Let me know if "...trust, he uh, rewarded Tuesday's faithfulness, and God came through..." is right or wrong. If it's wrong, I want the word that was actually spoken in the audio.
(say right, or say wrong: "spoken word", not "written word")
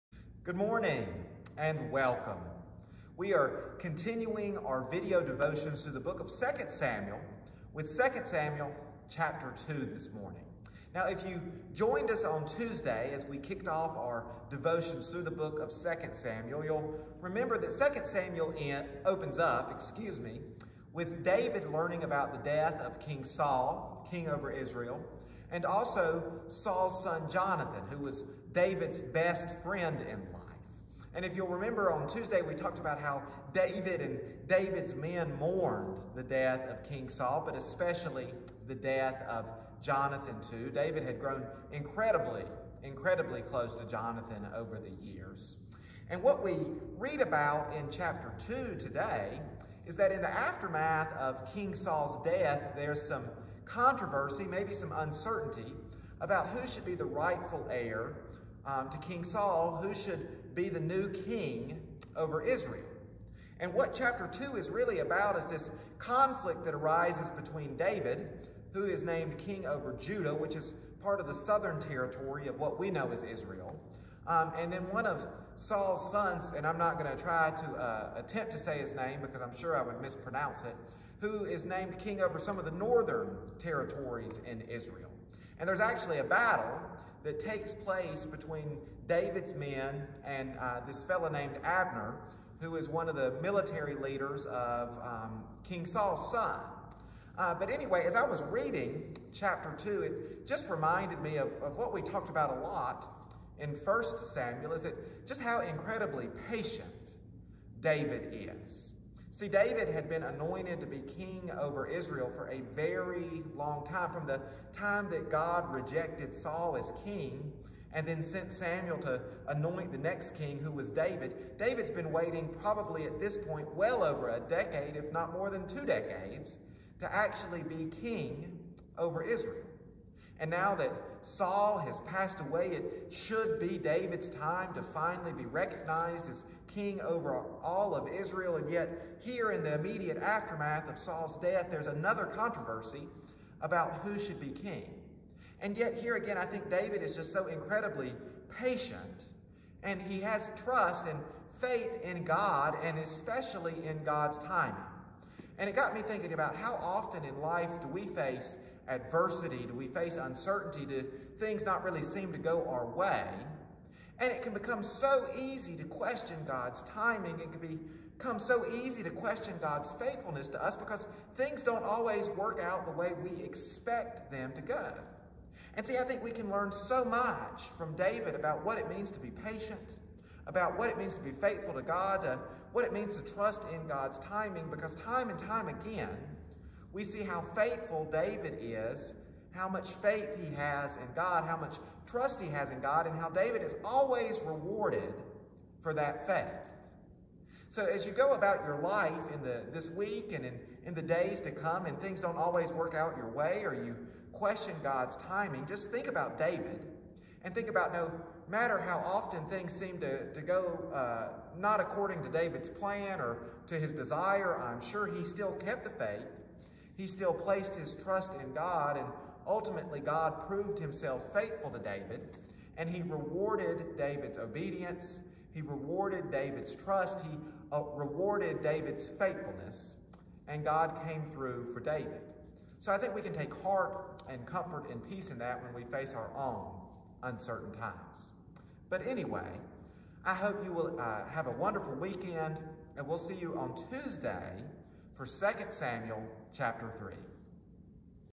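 wrong: "David", not "Tuesday".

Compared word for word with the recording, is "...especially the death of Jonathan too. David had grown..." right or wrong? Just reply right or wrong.
right.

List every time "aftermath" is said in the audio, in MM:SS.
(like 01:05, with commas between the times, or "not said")
00:50, 02:20.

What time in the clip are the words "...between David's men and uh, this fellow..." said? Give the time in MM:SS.
01:28.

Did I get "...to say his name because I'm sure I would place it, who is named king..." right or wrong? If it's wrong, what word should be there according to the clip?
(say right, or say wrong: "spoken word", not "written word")
wrong: "mispronounce", not "place".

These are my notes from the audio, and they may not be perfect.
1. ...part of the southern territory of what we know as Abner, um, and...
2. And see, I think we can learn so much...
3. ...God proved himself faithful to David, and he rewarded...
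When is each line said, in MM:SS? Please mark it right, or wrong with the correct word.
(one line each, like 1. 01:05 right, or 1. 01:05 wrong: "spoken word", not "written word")
1. 01:11 wrong: "Israel", not "Abner"
2. 02:55 right
3. 03:39 right.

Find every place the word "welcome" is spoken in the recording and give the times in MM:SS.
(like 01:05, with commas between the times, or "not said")
00:01.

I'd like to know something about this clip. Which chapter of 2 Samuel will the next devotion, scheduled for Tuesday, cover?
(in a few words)
Chapter 3.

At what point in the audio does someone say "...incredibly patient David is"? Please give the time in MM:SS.
01:45.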